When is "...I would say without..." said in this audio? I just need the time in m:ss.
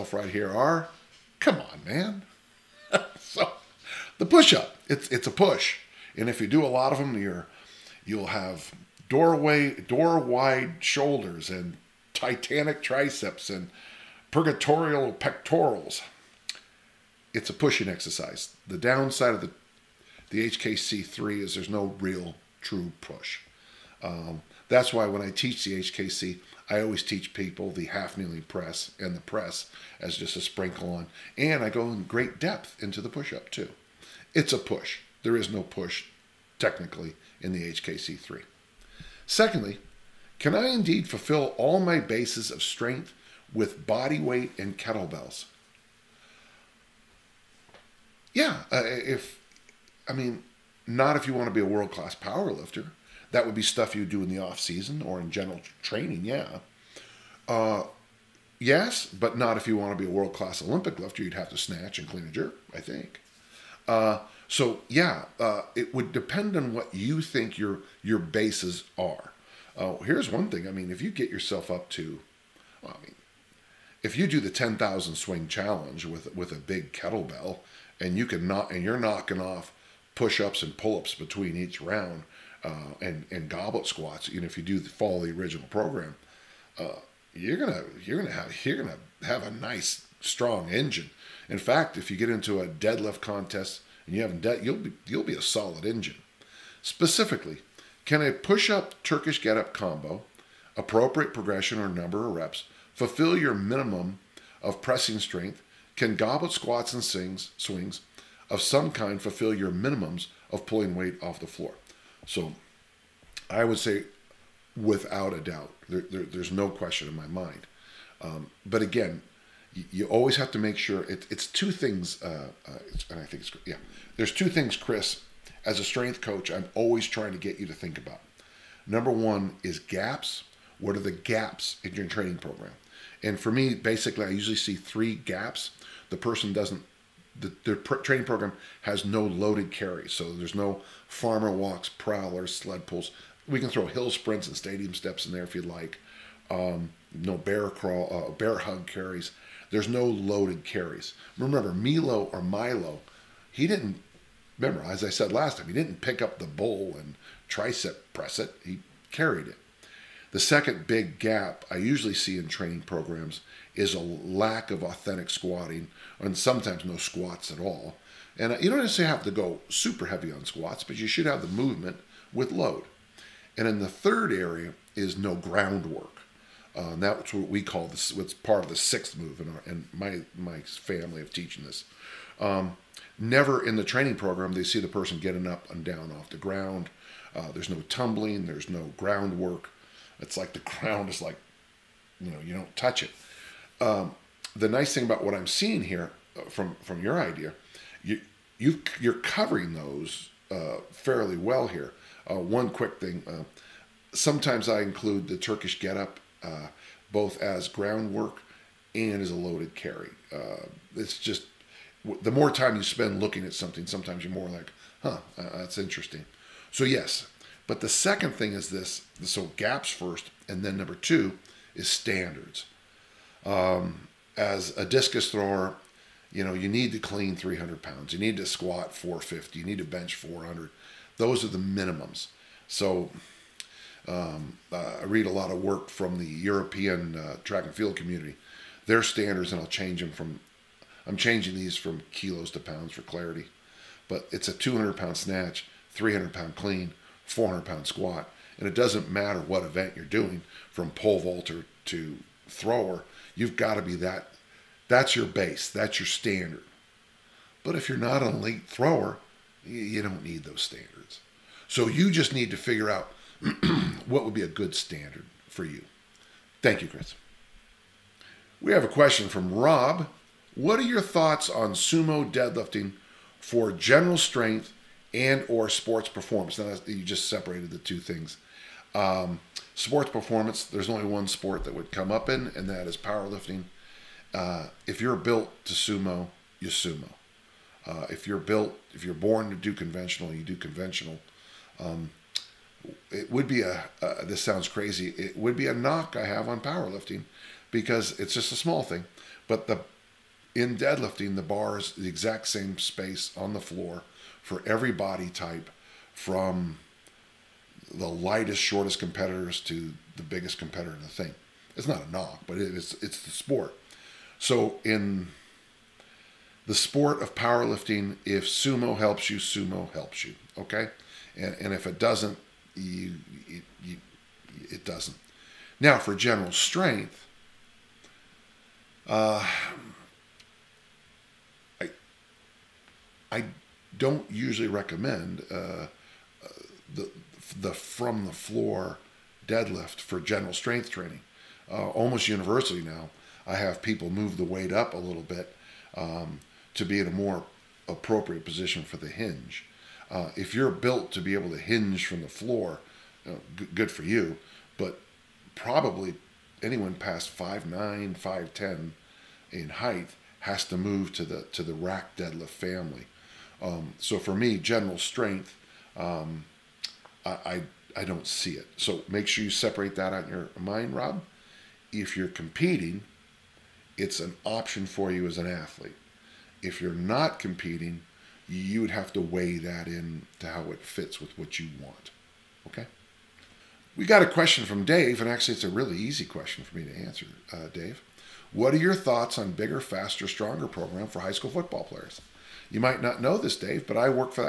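1:53.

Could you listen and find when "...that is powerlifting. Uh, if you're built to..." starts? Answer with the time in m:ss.
4:42.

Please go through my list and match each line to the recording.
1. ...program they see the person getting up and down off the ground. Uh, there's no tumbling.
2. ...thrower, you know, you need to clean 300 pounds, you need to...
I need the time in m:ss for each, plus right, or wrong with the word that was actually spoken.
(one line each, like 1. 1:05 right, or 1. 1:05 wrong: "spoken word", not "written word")
1. 3:04 right
2. 3:45 right.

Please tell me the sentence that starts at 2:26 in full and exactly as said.
Um, no bear crawl, uh, bear hug carries there's no loaded carries.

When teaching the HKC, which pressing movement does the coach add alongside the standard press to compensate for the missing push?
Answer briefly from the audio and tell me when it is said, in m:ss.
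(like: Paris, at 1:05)
half kneeling press, at 0:27.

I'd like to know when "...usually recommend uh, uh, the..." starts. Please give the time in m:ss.
5:34.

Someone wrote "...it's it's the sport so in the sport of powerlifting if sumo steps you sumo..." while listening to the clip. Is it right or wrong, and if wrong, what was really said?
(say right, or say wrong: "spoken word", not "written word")
wrong: "helps", not "steps".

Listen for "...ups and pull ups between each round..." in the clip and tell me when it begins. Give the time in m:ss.
1:20.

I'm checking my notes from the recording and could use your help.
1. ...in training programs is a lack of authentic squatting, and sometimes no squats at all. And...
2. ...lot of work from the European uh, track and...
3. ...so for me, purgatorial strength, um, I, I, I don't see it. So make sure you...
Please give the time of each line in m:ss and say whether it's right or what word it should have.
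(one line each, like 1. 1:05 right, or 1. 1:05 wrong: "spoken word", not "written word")
1. 2:42 right
2. 3:55 right
3. 6:03 wrong: "general", not "purgatorial".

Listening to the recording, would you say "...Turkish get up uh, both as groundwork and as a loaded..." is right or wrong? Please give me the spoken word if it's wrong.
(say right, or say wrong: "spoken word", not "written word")
right.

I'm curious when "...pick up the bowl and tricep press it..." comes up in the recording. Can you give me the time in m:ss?
2:36.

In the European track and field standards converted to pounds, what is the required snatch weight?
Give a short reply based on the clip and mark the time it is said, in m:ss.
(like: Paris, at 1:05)
200 pounds, at 4:04.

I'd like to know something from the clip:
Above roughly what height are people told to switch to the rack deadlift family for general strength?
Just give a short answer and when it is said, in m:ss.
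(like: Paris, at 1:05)
5'9"-5'10", at 5:57.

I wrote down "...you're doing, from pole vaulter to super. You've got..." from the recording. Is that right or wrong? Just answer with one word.
wrong.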